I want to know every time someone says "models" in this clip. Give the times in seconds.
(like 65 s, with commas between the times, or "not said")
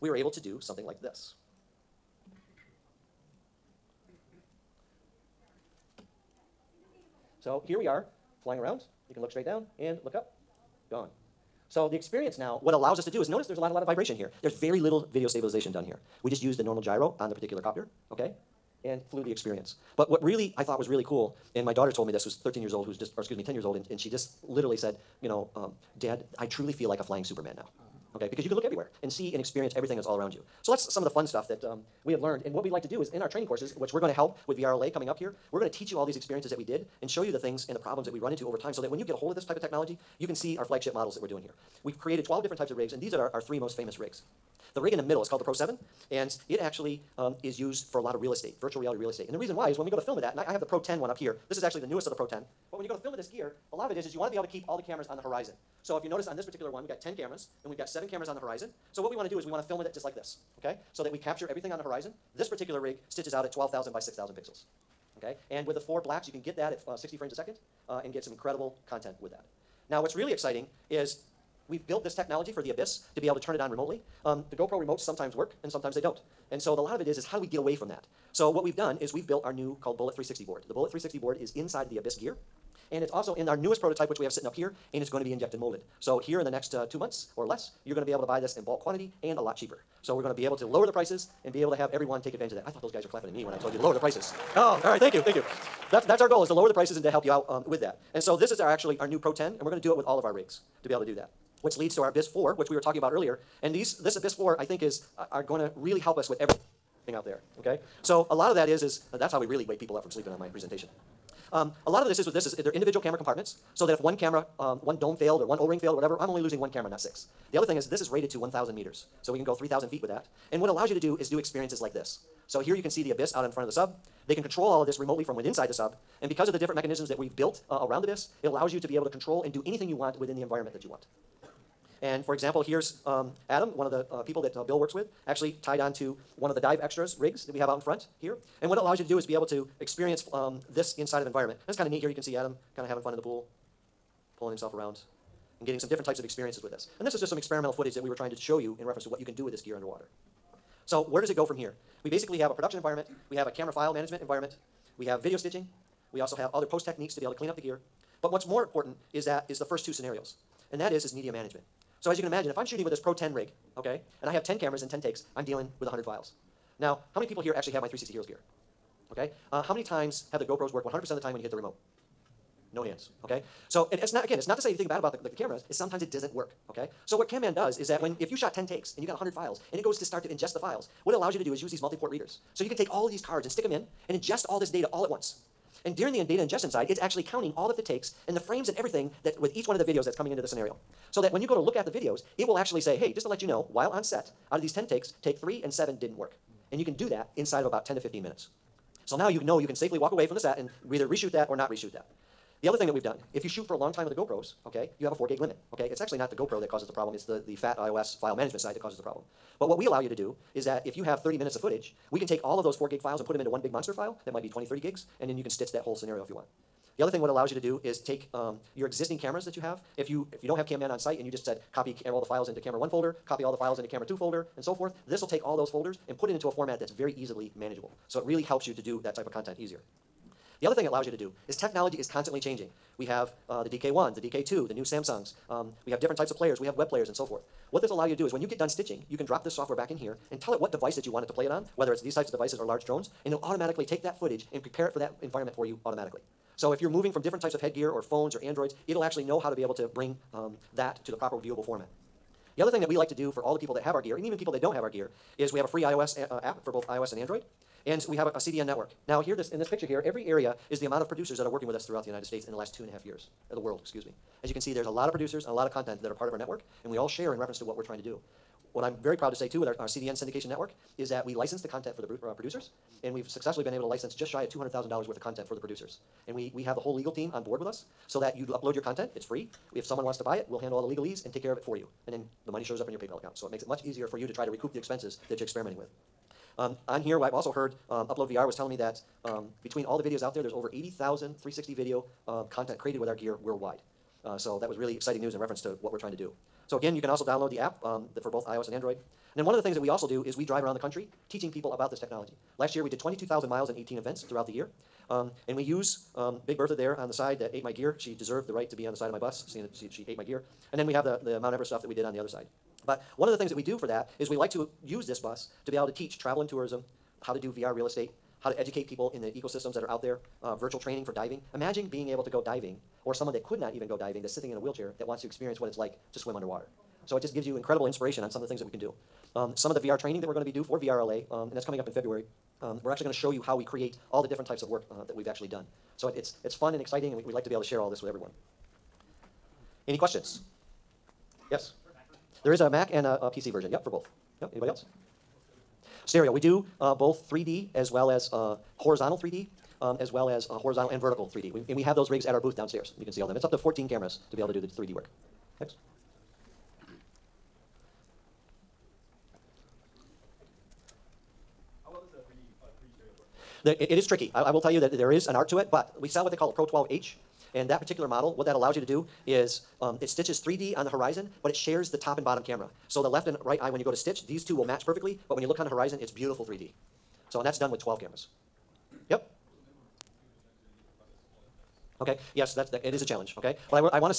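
40 s, 368 s.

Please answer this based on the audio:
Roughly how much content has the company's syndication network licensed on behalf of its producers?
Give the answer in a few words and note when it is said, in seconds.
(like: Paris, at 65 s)
just under $200,000, at 274 s.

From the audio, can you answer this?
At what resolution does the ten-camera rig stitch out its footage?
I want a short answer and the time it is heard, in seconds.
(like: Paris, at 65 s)
12,000 by 6,000 pixels, at 63 s.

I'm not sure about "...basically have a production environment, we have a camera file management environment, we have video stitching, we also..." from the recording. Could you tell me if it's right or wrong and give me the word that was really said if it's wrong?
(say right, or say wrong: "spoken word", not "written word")
right.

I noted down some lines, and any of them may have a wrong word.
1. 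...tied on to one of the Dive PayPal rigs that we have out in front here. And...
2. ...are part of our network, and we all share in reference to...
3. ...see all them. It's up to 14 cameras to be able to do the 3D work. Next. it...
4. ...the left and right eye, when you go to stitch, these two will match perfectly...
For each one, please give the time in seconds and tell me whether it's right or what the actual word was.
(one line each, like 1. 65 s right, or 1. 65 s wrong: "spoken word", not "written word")
1. 135 s wrong: "Xtras", not "PayPal"
2. 266 s right
3. 353 s right
4. 373 s right.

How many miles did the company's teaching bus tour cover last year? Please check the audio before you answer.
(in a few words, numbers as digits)
22,000 miles.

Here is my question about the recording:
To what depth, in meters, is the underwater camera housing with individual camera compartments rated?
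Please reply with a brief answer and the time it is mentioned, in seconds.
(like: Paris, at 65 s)
1,000 meters, at 118 s.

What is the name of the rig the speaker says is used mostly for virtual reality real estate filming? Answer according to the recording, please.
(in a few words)
Pro 7.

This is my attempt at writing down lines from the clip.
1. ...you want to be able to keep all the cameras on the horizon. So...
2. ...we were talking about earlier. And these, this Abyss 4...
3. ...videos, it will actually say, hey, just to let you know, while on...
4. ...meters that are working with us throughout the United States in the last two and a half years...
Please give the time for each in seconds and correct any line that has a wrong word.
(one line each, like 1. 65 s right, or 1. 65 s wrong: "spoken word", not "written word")
1. 54 s right
2. 102 s right
3. 191 s right
4. 261 s wrong: "producers", not "meters".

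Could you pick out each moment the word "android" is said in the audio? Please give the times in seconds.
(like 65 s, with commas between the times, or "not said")
248 s, 257 s, 298 s.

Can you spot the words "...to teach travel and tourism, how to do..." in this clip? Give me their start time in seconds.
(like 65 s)
315 s.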